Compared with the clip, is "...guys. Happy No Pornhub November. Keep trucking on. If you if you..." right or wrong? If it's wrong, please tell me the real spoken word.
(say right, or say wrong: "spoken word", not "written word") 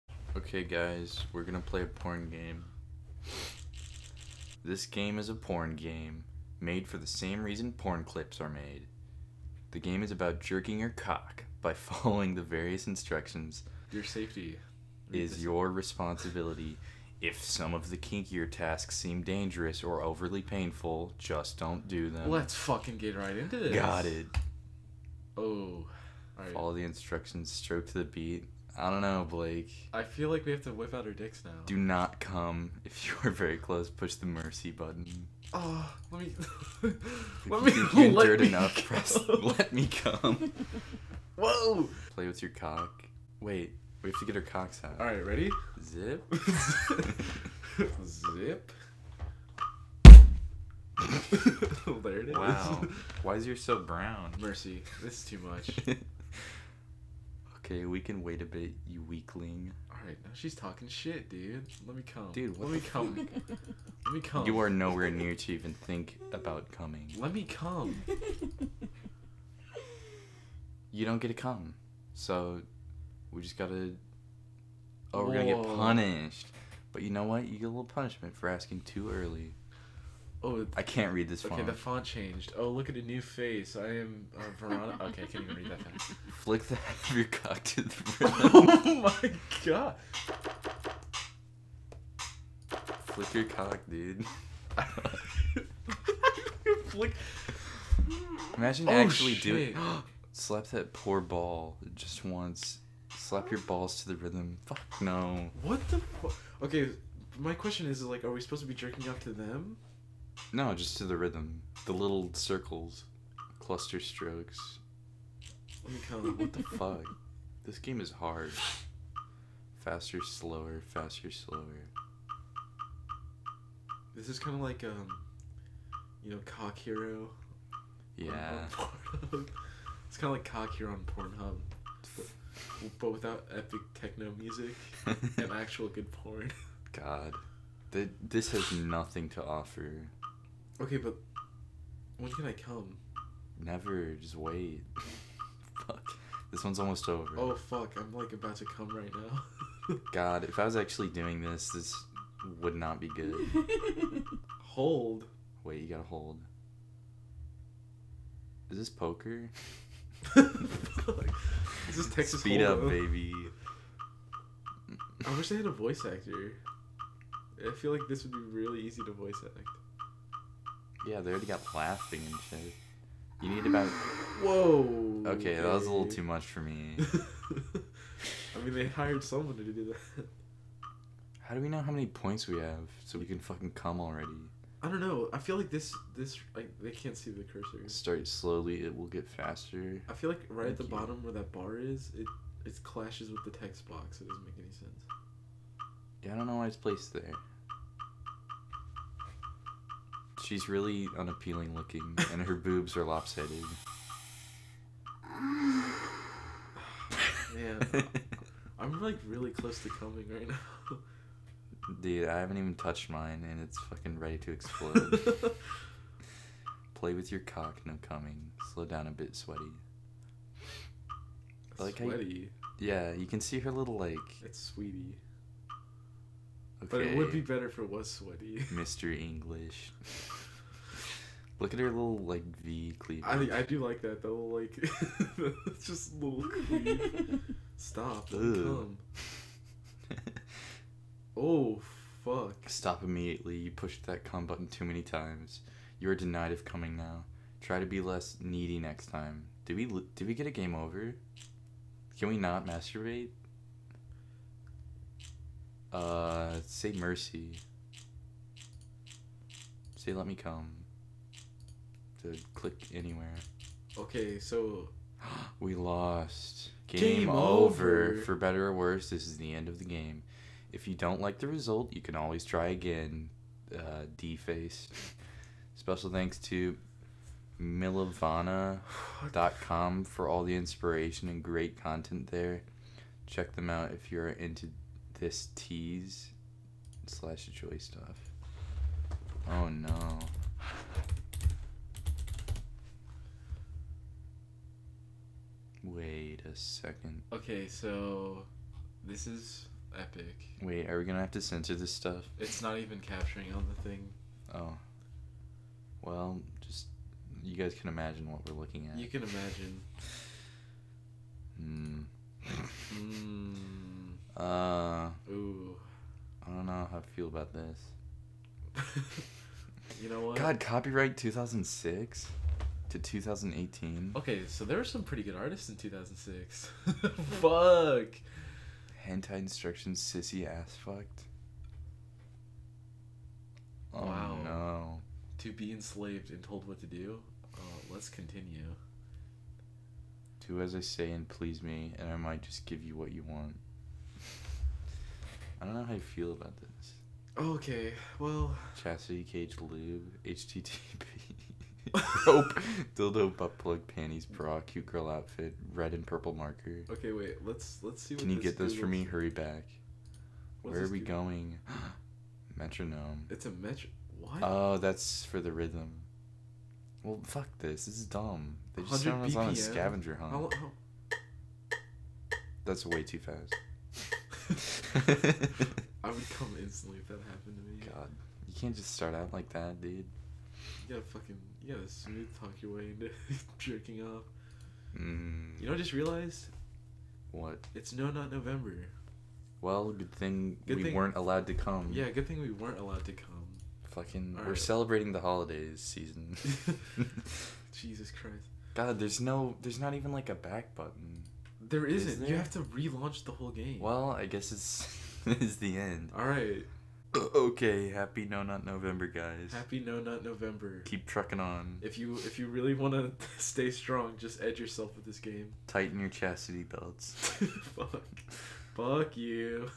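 wrong: "Nut", not "Pornhub".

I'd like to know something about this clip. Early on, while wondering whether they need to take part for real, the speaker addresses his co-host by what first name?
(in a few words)
Blake.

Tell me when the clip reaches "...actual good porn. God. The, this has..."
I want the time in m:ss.
2:15.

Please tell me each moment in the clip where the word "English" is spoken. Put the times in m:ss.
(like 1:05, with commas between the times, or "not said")
3:49.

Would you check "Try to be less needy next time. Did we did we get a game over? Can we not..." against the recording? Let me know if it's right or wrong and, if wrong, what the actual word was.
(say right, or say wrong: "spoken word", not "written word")
right.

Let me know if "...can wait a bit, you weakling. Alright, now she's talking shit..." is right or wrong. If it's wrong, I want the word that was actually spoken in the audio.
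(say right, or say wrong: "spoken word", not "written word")
right.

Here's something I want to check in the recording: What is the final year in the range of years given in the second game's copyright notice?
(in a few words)
2018.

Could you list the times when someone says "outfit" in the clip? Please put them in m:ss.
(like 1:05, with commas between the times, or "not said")
5:55.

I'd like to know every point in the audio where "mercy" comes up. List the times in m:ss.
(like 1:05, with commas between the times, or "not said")
0:34, 0:54, 4:16.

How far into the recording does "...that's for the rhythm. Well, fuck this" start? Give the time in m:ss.
6:04.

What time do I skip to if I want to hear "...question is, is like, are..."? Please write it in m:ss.
1:47.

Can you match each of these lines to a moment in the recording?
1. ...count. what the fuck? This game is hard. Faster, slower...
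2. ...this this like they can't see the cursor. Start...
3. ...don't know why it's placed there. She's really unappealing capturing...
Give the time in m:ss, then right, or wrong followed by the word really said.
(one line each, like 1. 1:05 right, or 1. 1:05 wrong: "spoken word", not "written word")
1. 1:56 right
2. 3:05 right
3. 3:16 wrong: "looking", not "capturing".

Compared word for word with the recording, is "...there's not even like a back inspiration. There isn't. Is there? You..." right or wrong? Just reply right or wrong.
wrong.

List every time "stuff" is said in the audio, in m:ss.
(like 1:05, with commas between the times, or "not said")
4:47, 5:01.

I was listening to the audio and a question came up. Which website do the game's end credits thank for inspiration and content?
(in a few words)
milovana.com.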